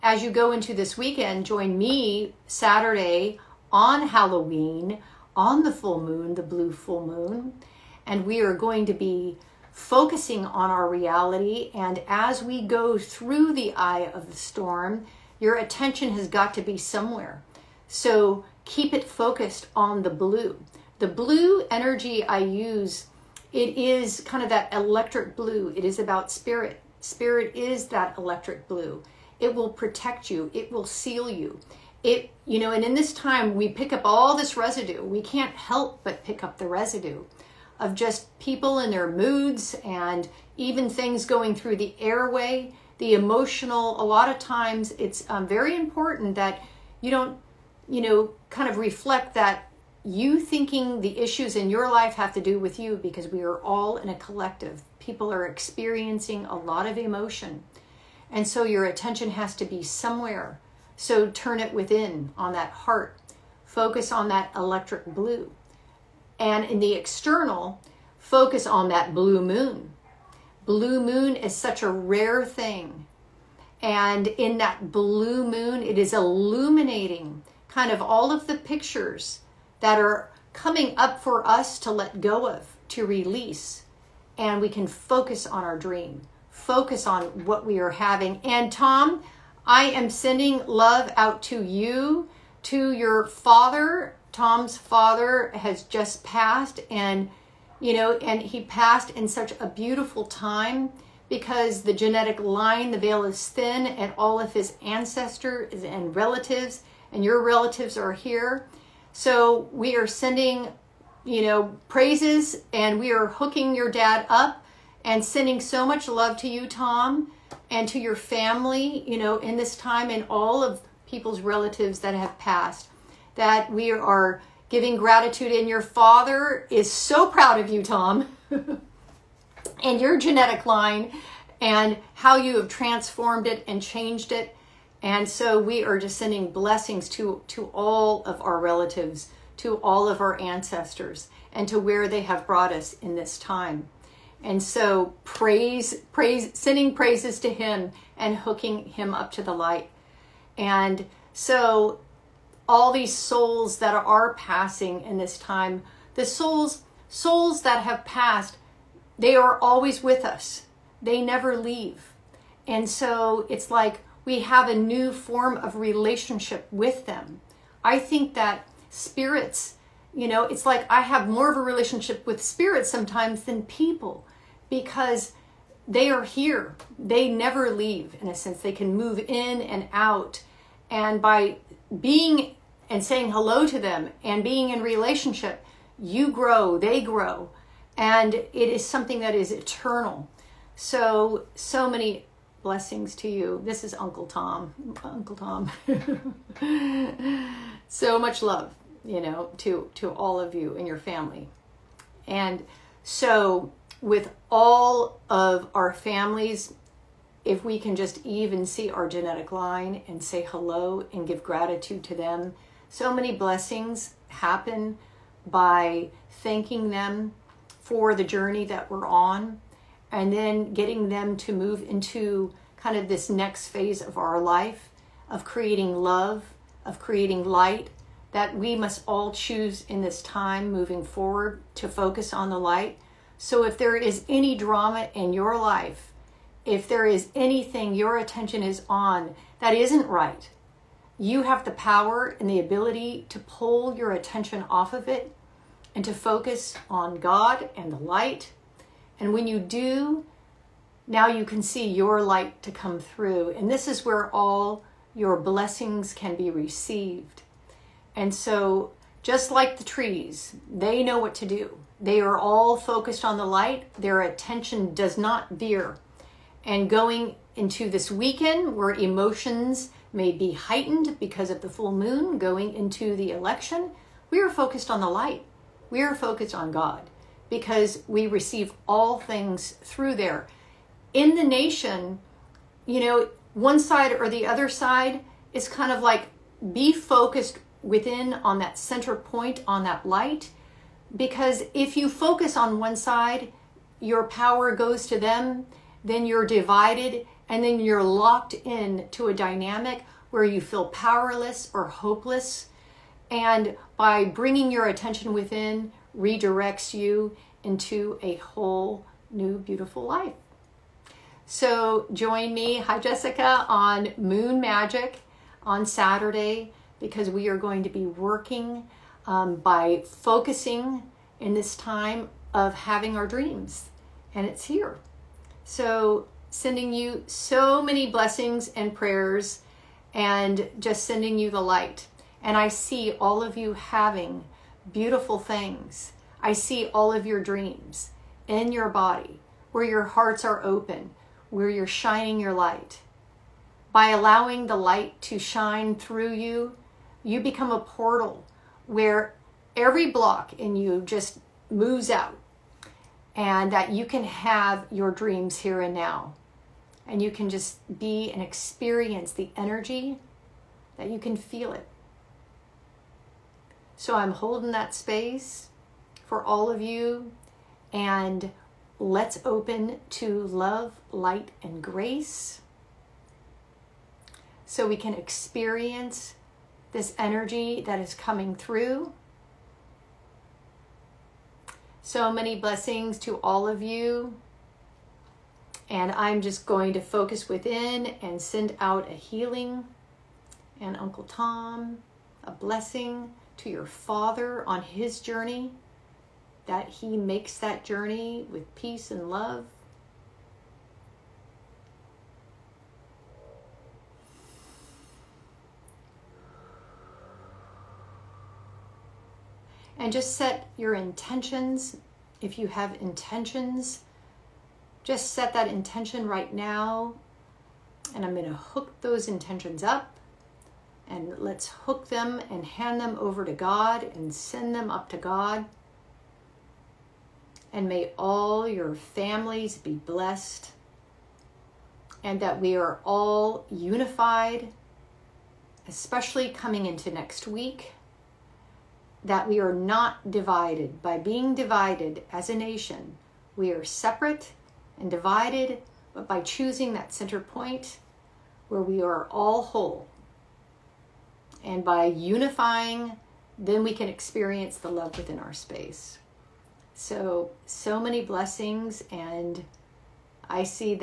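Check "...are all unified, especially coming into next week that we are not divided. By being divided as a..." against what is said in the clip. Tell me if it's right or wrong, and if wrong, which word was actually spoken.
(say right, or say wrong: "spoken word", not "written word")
right.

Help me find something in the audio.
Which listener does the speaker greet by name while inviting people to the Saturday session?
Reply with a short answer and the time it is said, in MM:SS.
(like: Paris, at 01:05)
Jessica, at 05:12.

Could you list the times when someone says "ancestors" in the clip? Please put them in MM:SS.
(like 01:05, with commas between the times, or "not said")
01:44, 02:20.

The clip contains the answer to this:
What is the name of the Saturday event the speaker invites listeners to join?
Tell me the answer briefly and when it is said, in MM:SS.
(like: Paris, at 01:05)
Moon Magic, at 05:14.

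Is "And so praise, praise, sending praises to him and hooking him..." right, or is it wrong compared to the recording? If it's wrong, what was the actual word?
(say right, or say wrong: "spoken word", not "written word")
right.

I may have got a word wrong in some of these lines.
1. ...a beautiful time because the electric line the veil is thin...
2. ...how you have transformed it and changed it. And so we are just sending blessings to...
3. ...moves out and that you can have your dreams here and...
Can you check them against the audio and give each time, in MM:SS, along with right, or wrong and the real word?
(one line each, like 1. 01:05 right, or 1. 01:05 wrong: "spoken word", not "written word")
1. 01:39 wrong: "genetic", not "electric"
2. 02:12 right
3. 05:51 right.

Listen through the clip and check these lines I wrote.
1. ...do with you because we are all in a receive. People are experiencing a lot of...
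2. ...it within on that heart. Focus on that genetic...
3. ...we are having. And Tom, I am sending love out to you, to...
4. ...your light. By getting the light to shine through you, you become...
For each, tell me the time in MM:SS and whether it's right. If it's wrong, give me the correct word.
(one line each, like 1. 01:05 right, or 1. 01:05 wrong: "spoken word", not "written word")
1. 00:52 wrong: "collective", not "receive"
2. 01:01 wrong: "electric", not "genetic"
3. 01:27 right
4. 05:42 wrong: "allowing", not "getting".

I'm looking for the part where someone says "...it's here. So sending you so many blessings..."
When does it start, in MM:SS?
05:24.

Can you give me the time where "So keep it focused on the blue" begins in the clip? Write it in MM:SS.
00:17.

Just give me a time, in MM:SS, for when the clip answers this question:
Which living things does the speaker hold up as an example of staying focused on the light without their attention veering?
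04:19.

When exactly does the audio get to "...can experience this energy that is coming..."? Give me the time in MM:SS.
06:14.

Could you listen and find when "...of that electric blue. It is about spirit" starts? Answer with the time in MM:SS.
00:24.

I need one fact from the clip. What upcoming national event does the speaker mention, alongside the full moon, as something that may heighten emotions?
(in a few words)
The election.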